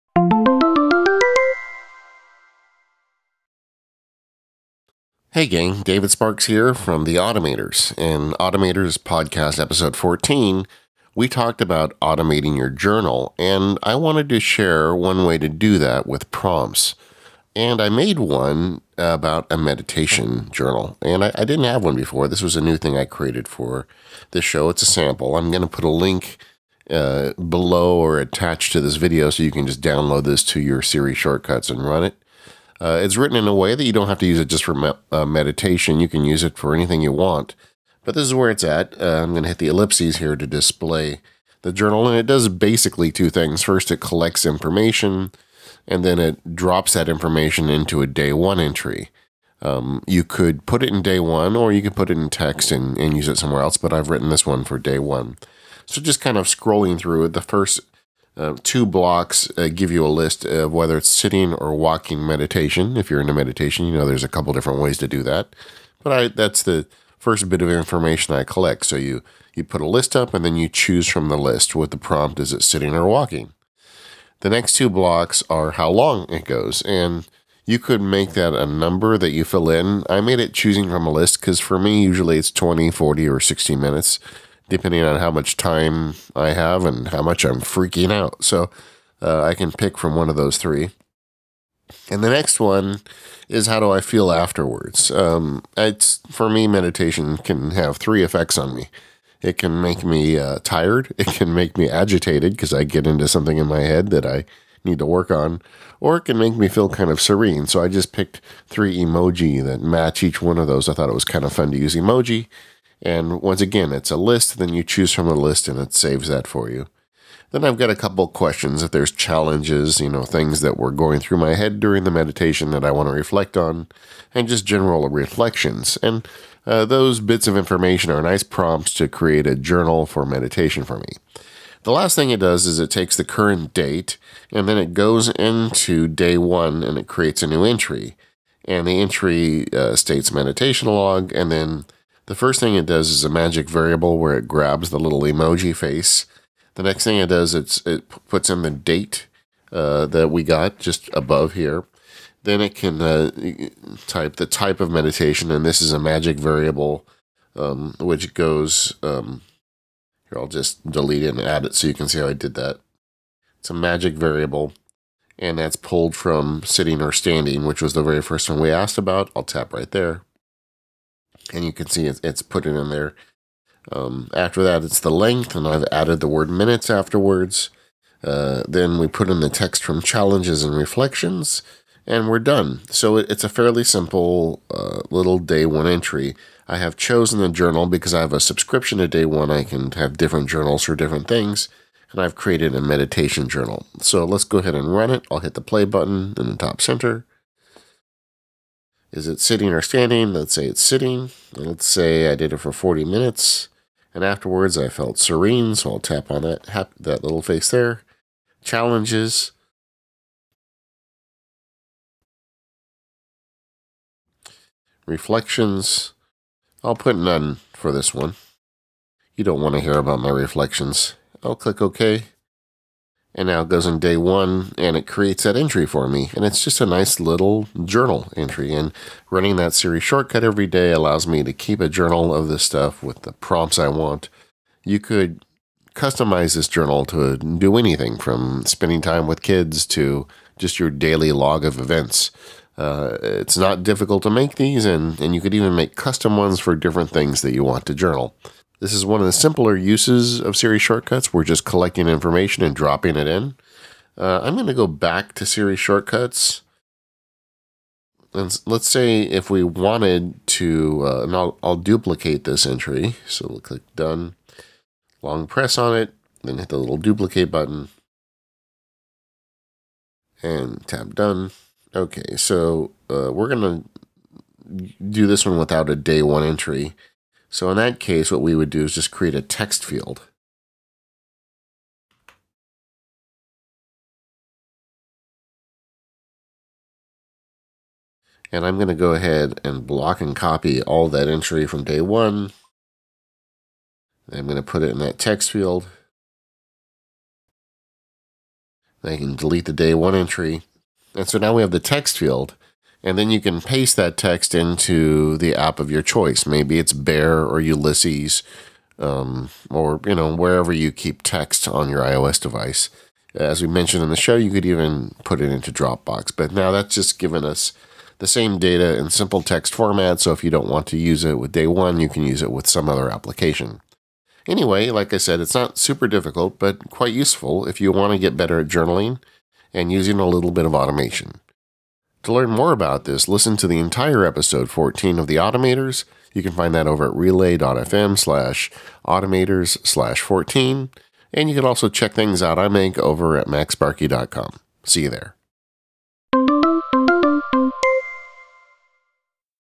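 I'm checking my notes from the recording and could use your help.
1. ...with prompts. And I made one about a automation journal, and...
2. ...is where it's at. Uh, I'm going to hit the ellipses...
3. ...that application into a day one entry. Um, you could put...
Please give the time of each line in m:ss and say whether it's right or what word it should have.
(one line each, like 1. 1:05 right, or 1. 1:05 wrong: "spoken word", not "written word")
1. 0:16 wrong: "meditation", not "automation"
2. 0:38 right
3. 0:46 wrong: "information", not "application".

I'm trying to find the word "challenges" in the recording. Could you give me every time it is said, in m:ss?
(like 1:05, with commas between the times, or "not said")
1:59, 3:00, 3:28.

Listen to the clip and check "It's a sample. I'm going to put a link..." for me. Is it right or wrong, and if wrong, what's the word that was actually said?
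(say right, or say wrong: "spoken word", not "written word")
right.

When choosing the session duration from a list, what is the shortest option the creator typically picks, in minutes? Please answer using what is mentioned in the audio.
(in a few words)
20.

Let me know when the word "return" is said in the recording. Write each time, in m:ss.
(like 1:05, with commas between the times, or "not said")
not said.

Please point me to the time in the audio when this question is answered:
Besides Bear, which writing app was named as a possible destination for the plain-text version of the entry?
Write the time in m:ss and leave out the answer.
5:07.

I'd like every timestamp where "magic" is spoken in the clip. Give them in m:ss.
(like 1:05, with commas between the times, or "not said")
2:23, 2:35, 2:43.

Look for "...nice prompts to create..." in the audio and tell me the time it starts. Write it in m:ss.
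2:08.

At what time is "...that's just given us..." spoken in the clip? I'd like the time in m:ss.
5:16.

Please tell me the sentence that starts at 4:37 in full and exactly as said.
So in that case, what we would do is just create a text field.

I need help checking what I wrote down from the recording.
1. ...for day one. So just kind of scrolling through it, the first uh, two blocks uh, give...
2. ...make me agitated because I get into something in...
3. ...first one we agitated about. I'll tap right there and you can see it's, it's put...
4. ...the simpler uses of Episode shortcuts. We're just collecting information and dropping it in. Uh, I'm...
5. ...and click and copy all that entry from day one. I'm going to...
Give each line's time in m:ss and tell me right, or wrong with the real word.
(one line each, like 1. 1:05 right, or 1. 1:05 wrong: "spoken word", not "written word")
1. 0:54 right
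2. 1:41 right
3. 2:48 wrong: "asked", not "agitated"
4. 4:09 wrong: "Siri", not "Episode"
5. 4:49 wrong: "block", not "click".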